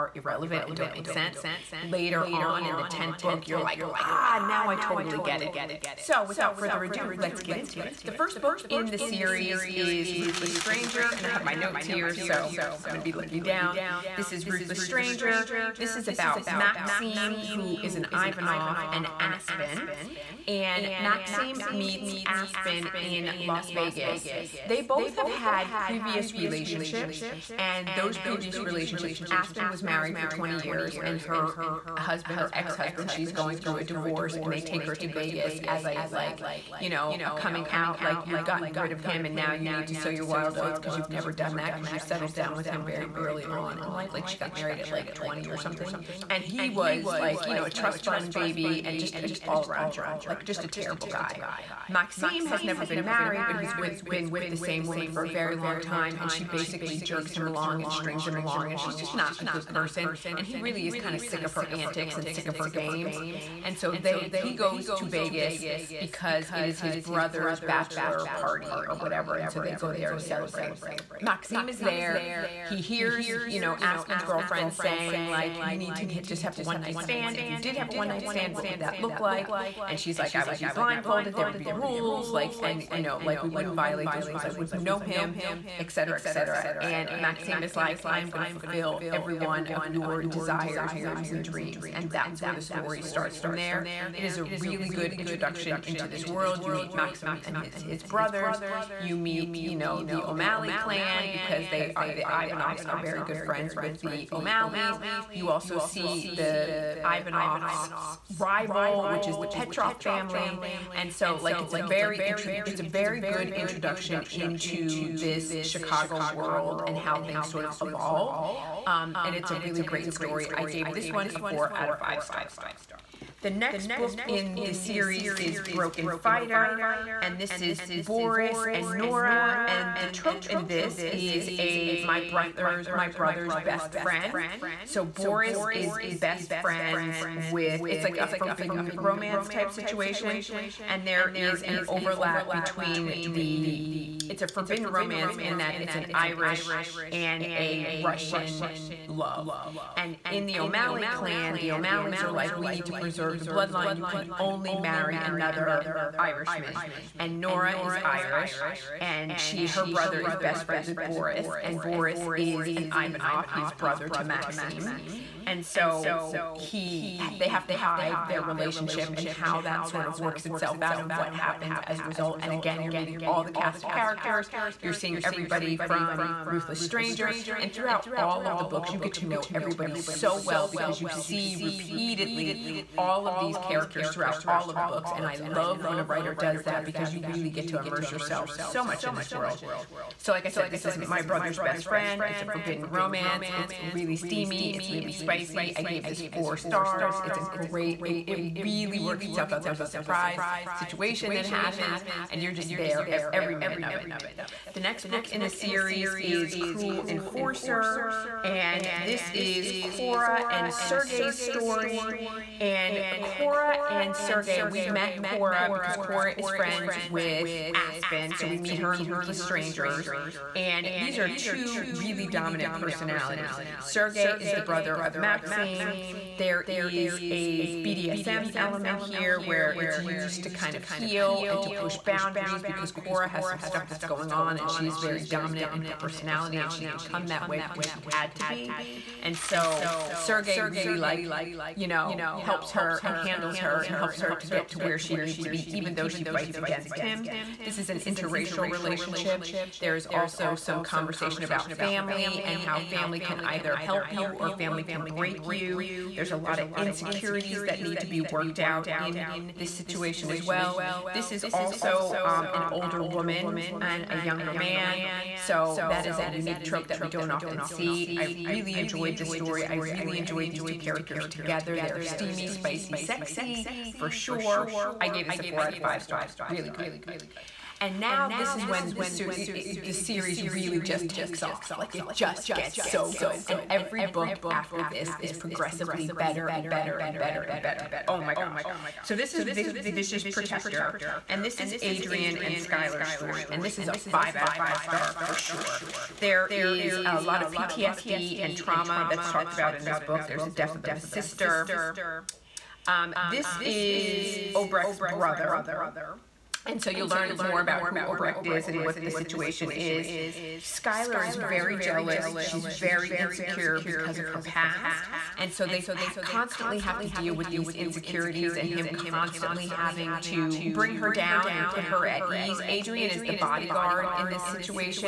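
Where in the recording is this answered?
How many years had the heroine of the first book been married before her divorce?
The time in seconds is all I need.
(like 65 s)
30 s.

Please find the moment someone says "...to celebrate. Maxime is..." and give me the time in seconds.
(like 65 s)
70 s.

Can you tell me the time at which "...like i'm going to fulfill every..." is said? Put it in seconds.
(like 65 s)
87 s.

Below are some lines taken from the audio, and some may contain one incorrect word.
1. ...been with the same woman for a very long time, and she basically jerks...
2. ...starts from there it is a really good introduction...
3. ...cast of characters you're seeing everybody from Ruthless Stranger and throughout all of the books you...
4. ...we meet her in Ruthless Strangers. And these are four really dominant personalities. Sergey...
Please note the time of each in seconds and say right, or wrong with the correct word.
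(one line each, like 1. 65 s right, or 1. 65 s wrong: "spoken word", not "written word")
1. 54 s right
2. 93 s right
3. 173 s right
4. 218 s wrong: "two", not "four".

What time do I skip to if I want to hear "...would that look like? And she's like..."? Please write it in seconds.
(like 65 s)
78 s.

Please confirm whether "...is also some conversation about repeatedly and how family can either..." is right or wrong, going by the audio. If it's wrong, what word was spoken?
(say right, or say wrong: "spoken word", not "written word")
wrong: "family", not "repeatedly".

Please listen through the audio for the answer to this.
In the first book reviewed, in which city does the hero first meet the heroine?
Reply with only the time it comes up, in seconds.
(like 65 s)
23 s.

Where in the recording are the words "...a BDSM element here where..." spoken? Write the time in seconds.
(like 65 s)
227 s.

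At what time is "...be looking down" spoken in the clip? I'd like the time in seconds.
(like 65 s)
13 s.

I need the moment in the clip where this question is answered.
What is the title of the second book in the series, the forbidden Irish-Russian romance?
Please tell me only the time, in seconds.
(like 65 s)
125 s.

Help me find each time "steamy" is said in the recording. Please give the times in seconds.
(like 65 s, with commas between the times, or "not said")
194 s, 272 s.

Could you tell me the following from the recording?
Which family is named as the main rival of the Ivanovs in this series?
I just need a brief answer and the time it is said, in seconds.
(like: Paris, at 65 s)
Petrov, at 109 s.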